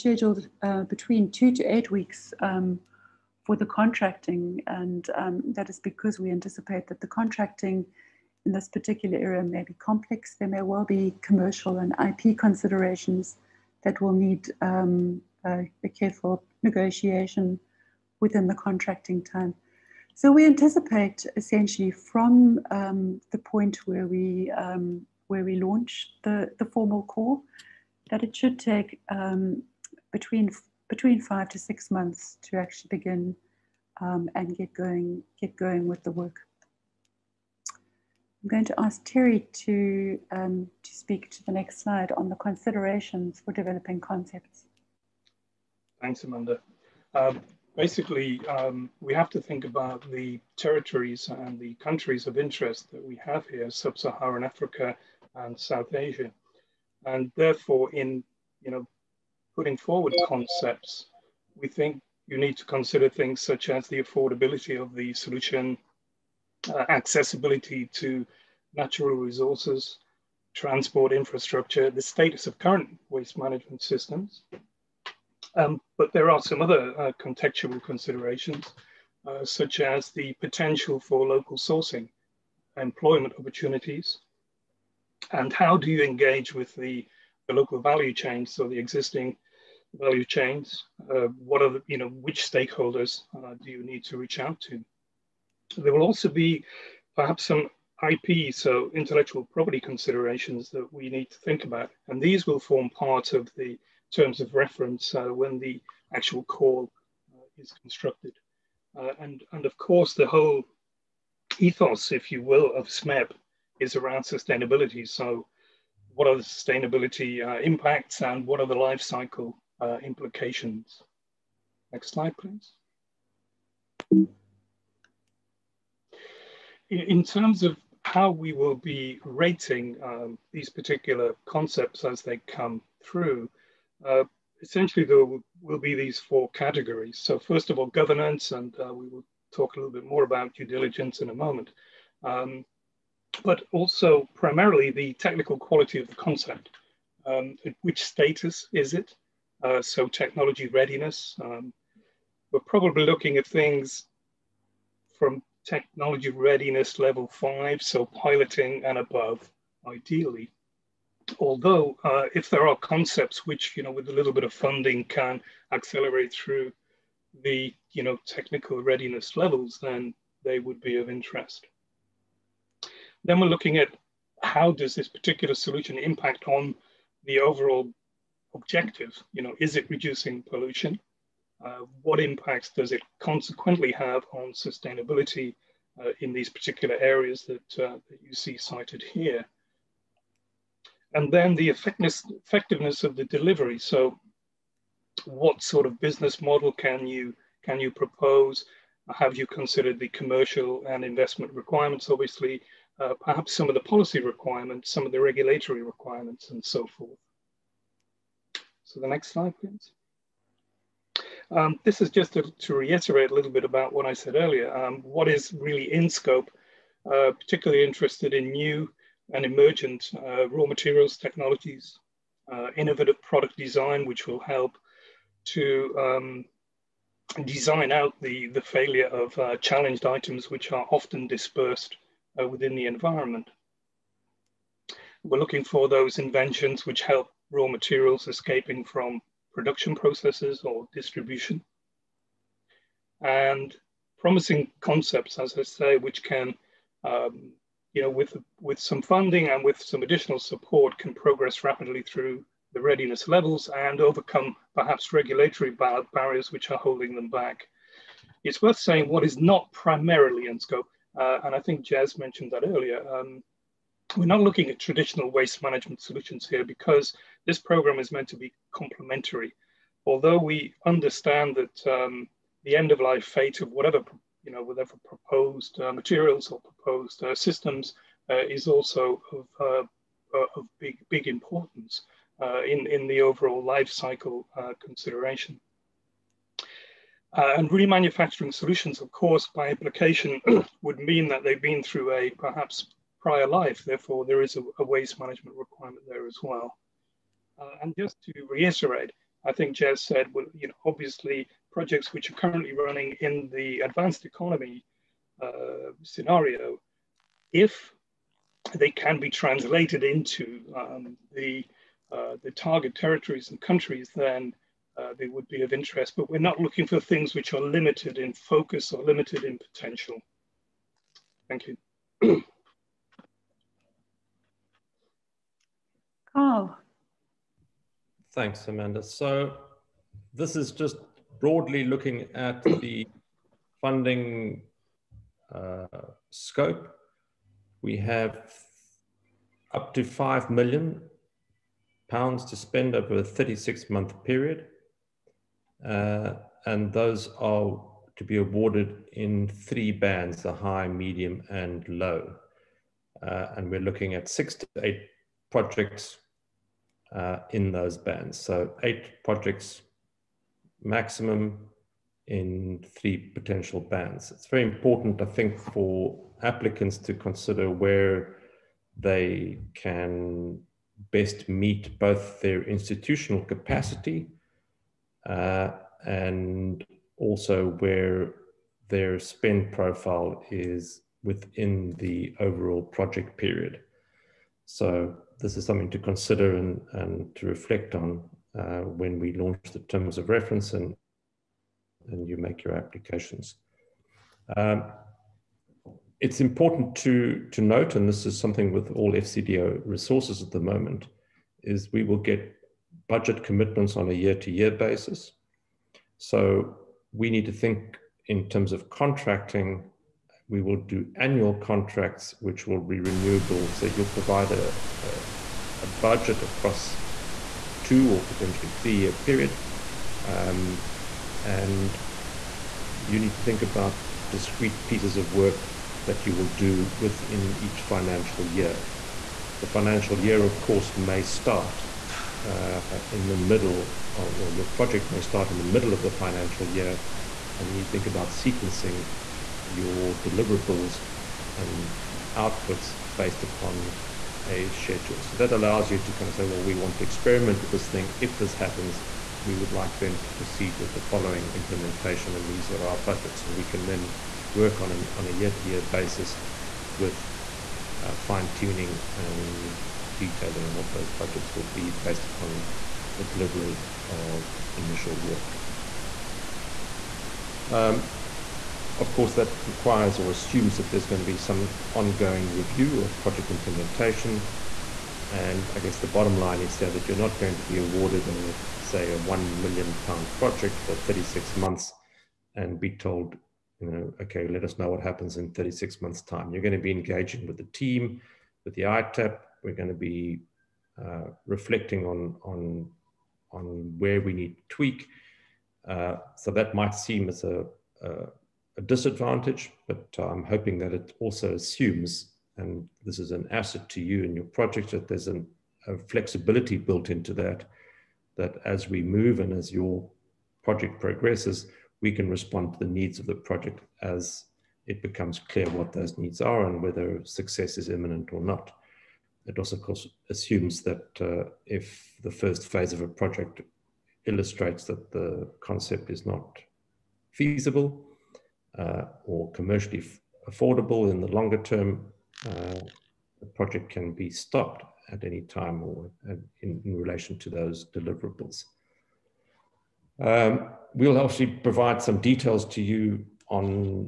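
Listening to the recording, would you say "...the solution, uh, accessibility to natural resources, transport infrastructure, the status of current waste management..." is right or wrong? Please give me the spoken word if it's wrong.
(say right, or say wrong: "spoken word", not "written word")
right.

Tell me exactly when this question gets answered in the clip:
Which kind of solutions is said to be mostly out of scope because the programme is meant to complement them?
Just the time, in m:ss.
4:24.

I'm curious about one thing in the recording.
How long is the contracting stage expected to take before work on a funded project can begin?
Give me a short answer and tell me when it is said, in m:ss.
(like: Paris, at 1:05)
2 to 8 weeks, at 0:01.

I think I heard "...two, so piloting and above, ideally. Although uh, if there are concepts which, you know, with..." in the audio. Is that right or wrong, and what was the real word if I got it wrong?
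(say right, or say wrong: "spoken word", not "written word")
wrong: "five", not "two".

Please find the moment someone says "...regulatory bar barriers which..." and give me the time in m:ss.
4:15.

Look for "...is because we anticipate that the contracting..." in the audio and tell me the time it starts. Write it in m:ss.
0:05.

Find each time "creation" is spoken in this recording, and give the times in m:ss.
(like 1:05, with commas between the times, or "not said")
not said.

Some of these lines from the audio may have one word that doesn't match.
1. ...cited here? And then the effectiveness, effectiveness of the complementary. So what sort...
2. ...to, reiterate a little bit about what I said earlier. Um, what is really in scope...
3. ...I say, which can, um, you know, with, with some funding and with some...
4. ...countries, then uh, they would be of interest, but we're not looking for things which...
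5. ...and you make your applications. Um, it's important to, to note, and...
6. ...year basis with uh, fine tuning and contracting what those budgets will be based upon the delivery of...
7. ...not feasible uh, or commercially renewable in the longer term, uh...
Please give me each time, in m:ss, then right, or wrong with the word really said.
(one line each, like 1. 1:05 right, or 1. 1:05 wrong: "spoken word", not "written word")
1. 3:08 wrong: "delivery", not "complementary"
2. 3:32 right
3. 4:05 right
4. 5:13 right
5. 6:32 right
6. 7:35 wrong: "detailing", not "contracting"
7. 8:46 wrong: "affordable", not "renewable".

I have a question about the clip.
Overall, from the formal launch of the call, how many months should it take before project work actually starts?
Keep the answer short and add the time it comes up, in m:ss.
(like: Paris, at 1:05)
5 to 6 months, at 0:31.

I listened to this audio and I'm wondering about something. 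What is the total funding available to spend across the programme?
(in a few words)
£5 million.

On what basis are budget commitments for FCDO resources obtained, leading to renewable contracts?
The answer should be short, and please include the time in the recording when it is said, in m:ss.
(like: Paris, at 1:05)
year-to-year, at 6:44.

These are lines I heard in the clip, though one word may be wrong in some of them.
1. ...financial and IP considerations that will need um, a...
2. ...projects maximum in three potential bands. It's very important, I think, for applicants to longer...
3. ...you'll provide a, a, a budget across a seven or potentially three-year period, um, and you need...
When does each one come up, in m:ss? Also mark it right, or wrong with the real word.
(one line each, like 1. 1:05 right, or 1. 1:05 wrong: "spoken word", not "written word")
1. 0:11 wrong: "commercial", not "financial"
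2. 5:59 wrong: "consider", not "longer"
3. 6:53 wrong: "two", not "seven".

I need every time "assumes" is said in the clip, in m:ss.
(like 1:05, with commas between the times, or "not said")
7:50, 8:21, 8:40.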